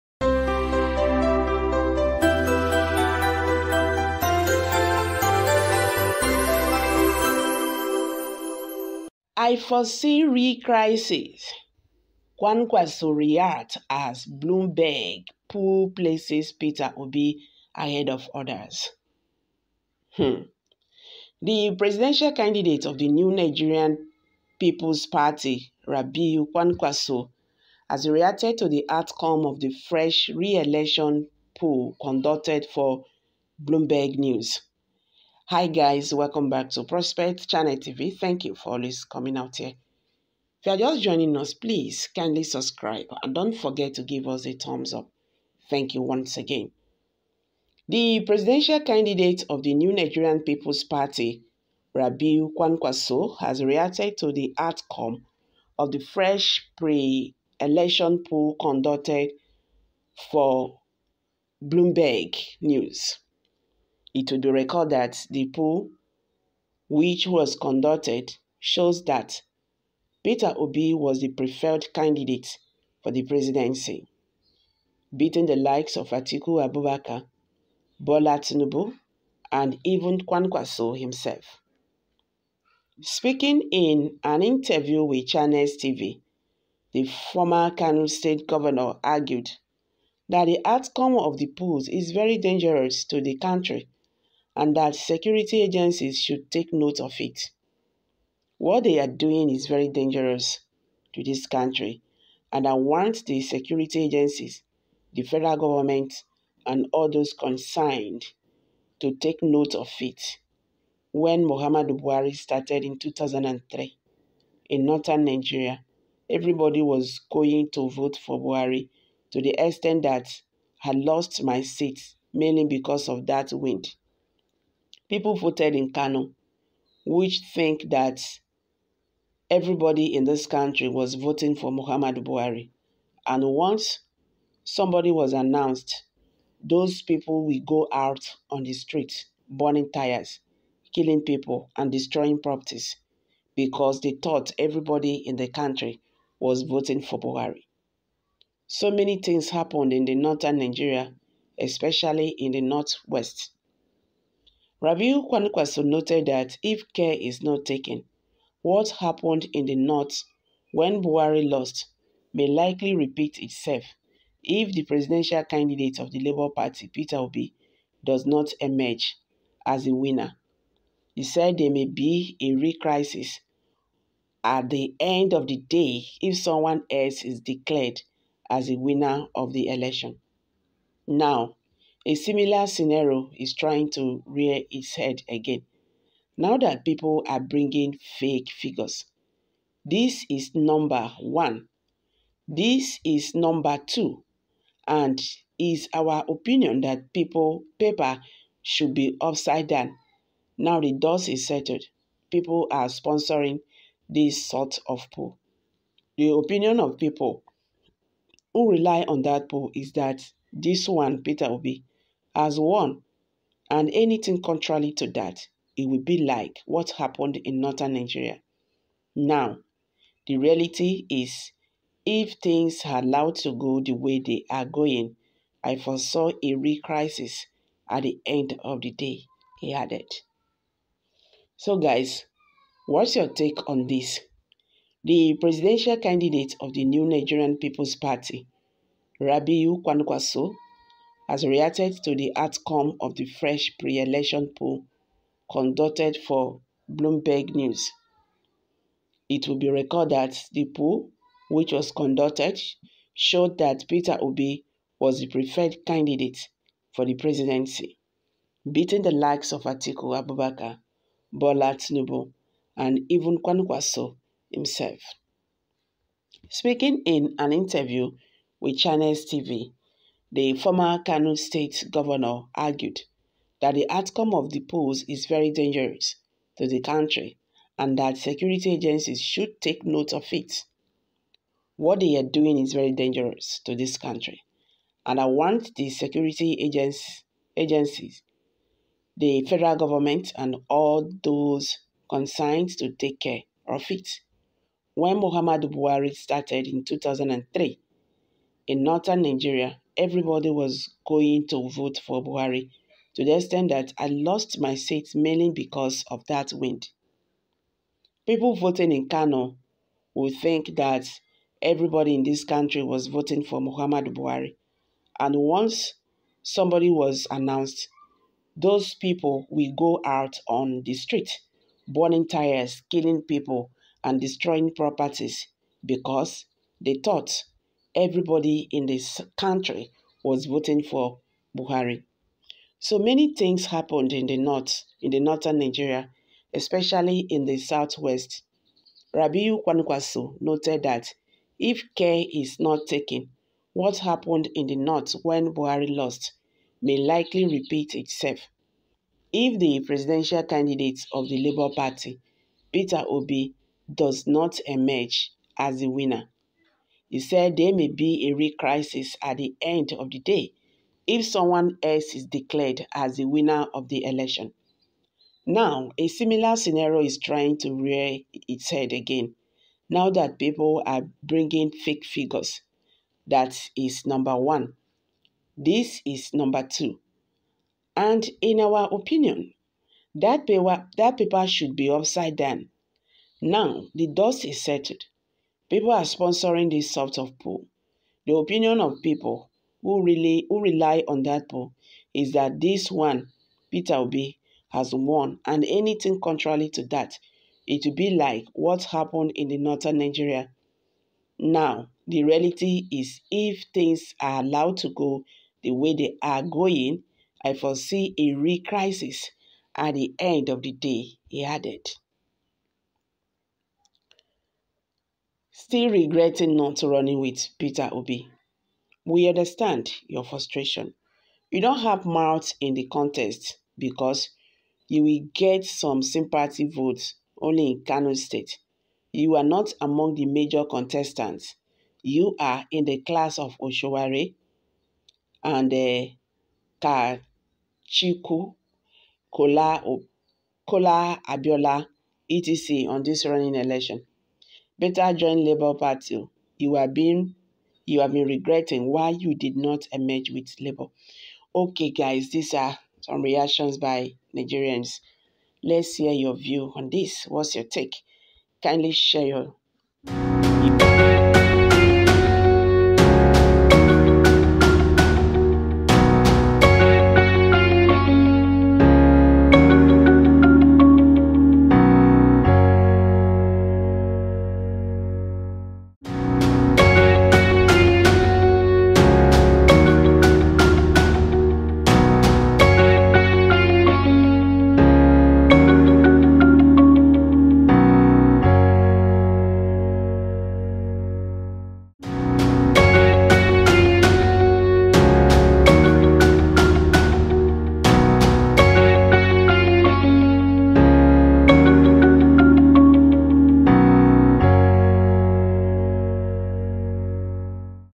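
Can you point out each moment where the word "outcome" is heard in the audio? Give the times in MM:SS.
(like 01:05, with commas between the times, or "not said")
00:28, 00:54, 01:30, 04:02, 04:33.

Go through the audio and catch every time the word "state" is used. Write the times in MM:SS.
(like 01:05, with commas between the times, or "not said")
01:28, 04:31, 07:08.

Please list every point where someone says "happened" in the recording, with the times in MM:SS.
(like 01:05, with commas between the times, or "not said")
02:29, 02:38, 03:36, 05:33, 05:43, 06:38.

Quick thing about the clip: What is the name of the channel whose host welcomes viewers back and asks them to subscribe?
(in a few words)
Prospect Channel TV.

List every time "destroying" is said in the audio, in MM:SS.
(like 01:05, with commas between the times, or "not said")
02:21, 05:24.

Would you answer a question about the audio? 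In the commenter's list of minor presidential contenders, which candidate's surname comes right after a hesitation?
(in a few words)
Kachikwu.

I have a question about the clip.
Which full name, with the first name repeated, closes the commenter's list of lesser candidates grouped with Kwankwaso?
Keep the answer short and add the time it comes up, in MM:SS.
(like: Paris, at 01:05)
Kola Abiola, at 07:20.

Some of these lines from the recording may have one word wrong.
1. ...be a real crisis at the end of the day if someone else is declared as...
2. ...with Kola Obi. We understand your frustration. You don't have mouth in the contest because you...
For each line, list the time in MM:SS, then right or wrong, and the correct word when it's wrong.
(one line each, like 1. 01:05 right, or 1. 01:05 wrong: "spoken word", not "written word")
1. 05:57 right
2. 06:57 wrong: "Peter", not "Kola".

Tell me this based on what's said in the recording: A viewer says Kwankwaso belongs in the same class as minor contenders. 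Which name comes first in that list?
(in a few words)
Oshoware.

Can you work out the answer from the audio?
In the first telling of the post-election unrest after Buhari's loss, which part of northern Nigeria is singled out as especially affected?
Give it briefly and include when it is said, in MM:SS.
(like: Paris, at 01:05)
Northwest, at 02:32.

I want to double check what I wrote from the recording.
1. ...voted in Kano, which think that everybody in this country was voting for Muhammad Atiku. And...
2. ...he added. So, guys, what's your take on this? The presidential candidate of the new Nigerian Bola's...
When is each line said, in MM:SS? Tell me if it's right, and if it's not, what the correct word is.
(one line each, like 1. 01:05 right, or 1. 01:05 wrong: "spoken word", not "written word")
1. 02:05 wrong: "Buhari", not "Atiku"
2. 03:49 wrong: "People", not "Bola".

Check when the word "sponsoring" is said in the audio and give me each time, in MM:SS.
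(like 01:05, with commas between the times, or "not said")
03:22, 06:26.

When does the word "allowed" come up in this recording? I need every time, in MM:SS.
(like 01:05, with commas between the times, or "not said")
03:43, 06:44.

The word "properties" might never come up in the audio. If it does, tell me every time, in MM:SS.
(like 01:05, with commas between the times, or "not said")
02:22, 05:24.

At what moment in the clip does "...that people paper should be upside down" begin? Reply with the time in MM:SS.
03:16.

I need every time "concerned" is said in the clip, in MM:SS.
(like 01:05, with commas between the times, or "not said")
01:47, 04:52.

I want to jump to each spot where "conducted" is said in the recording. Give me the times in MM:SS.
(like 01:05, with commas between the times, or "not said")
00:31, 00:58, 01:07, 04:05, 04:11.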